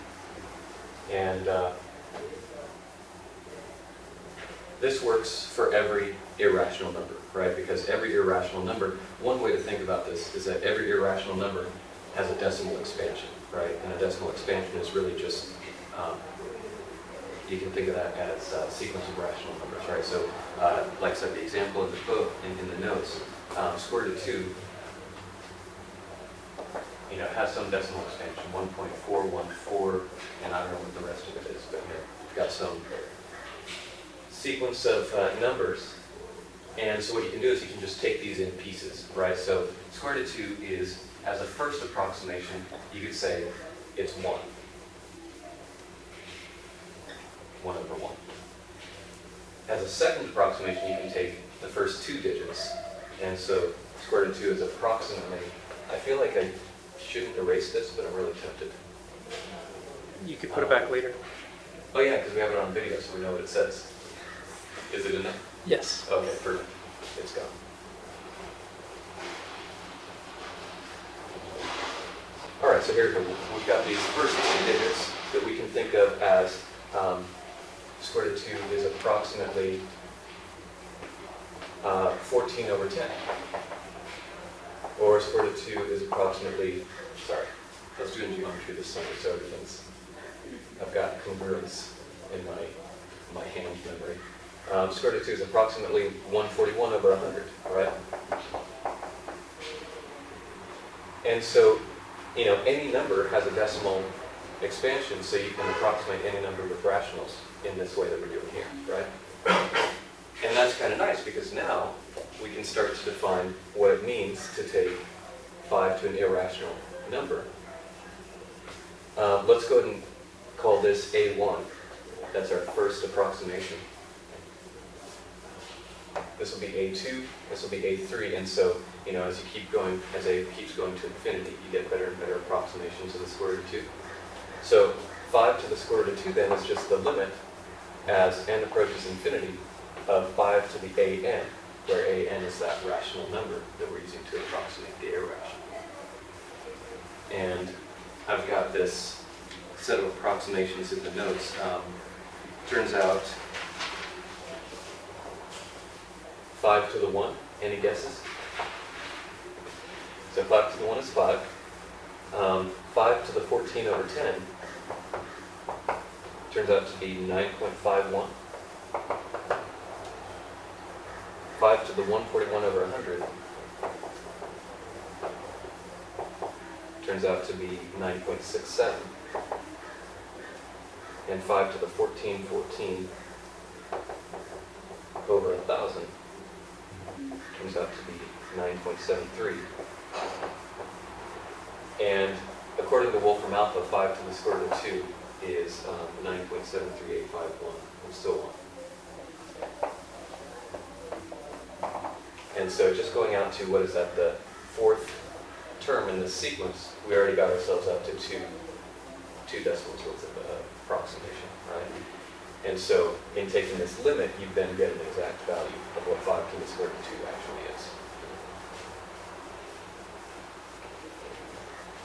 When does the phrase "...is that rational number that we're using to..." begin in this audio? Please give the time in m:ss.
2:22.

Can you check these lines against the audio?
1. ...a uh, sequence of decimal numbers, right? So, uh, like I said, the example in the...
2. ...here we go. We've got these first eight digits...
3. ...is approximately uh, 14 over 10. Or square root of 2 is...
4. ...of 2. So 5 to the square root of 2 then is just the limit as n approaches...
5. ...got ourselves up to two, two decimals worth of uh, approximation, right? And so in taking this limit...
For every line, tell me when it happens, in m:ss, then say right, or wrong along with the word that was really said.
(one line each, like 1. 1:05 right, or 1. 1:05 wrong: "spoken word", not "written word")
1. 0:18 wrong: "rational", not "decimal"
2. 1:12 wrong: "two", not "eight"
3. 1:18 right
4. 2:13 right
5. 3:27 right.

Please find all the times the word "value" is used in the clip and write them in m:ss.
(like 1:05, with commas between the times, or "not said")
3:35.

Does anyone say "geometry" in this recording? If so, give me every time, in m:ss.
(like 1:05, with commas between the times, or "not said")
1:28.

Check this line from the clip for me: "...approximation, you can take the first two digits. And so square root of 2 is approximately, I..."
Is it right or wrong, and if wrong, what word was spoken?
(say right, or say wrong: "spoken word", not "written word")
right.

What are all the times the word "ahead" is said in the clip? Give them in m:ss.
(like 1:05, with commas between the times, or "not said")
1:59.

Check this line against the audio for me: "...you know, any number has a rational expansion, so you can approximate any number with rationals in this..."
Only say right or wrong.
wrong.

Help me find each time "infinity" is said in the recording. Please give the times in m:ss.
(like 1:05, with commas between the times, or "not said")
2:11, 2:19.